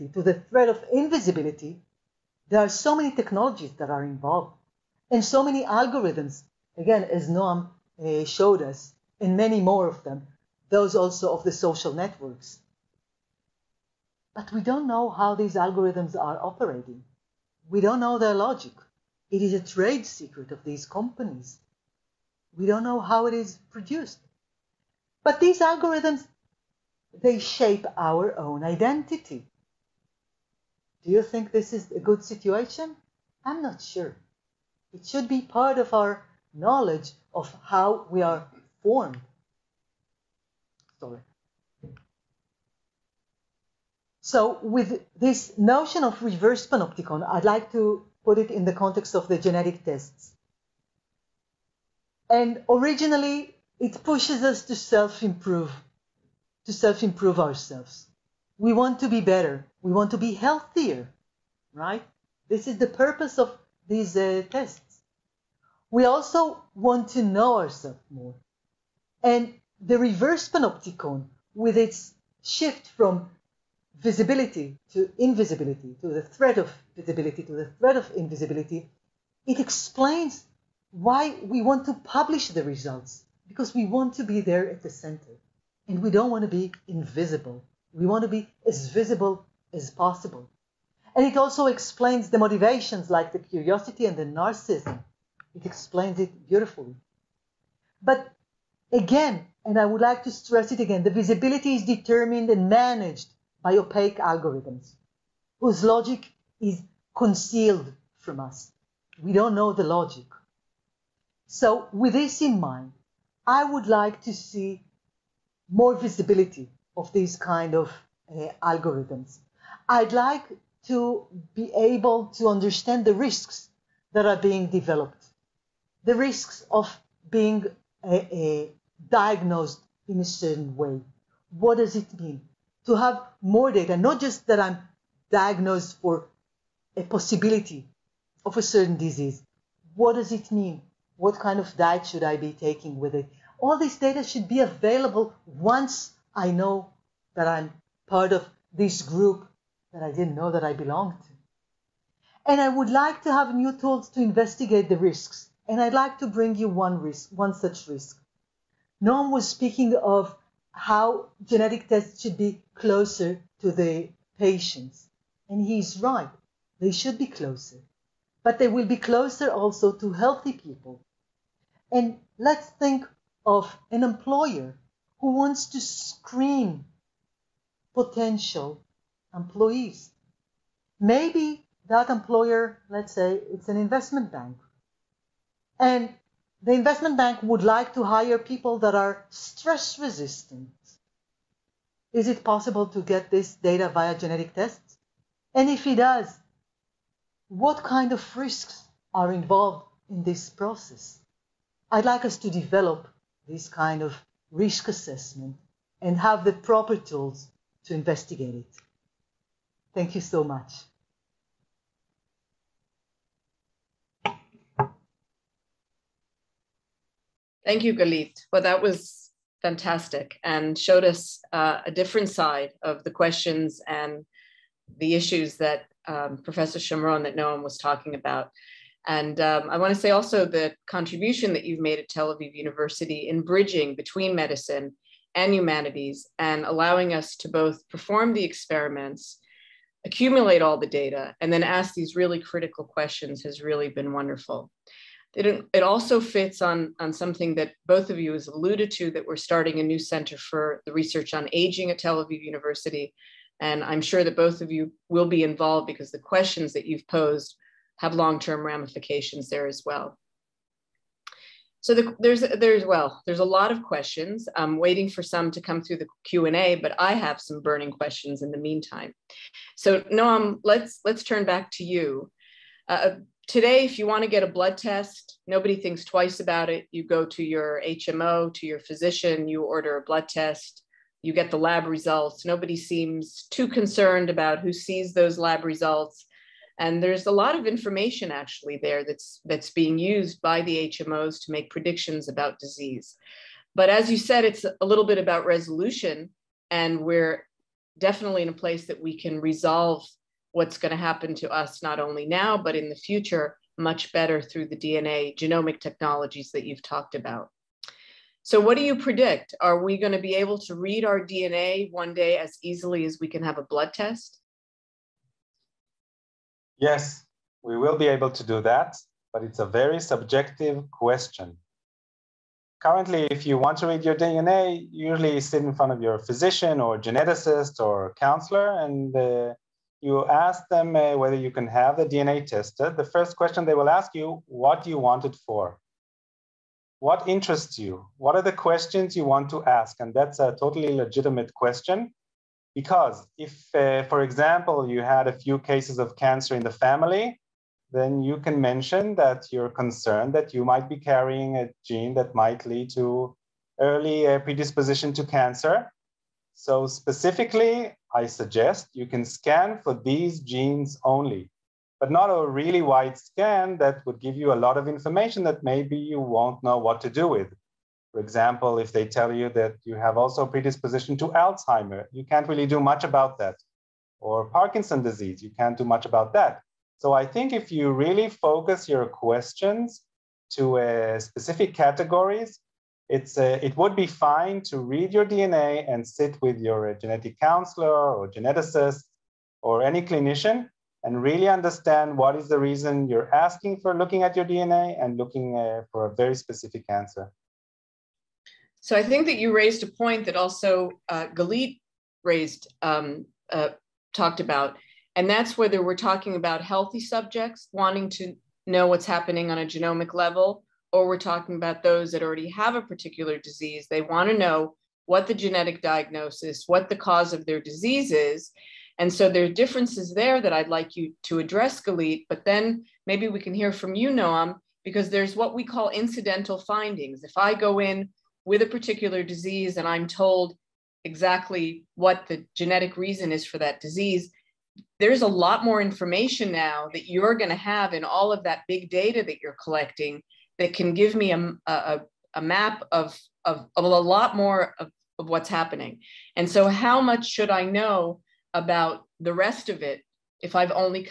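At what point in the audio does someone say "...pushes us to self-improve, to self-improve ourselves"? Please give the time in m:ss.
0:54.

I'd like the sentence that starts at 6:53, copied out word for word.
They want to know what the genetic diagnosis, what the cause of their disease is.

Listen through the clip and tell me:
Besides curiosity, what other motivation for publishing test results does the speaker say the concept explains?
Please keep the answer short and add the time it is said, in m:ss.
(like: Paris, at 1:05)
Narcissism, at 1:34.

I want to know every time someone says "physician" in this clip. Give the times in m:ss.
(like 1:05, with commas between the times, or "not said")
4:38, 5:26.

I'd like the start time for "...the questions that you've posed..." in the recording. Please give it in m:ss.
4:16.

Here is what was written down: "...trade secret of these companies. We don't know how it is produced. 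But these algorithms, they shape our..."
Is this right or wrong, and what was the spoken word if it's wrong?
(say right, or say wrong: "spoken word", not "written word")
right.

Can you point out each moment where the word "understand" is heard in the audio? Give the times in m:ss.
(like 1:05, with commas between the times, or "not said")
2:02, 6:31.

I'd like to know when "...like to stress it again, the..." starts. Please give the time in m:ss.
1:40.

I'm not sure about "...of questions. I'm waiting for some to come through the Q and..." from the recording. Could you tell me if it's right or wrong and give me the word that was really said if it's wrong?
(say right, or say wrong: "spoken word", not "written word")
right.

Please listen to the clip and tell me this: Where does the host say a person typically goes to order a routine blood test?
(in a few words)
HMO.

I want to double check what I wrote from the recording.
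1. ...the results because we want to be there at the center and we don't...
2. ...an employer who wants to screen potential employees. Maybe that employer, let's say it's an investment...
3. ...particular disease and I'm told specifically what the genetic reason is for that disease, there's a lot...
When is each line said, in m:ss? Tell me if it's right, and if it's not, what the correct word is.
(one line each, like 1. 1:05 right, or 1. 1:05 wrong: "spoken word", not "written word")
1. 1:22 right
2. 2:53 right
3. 7:08 wrong: "exactly", not "specifically".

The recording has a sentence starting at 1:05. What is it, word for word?
We also want to know ourselves more.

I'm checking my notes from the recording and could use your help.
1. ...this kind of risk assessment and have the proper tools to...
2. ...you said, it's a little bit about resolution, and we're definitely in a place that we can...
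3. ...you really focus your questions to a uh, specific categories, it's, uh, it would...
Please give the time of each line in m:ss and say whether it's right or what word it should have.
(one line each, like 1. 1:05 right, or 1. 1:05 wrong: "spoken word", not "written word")
1. 3:23 right
2. 4:54 right
3. 6:17 right.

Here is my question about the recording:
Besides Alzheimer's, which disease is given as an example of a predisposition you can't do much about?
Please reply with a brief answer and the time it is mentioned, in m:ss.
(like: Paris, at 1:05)
Parkinson disease, at 6:14.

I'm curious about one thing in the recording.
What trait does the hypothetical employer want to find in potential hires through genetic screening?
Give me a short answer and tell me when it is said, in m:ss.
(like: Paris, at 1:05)
Stress resistant, at 3:09.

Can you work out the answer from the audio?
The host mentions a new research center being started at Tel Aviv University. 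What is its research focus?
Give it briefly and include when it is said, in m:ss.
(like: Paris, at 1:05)
Aging, at 4:11.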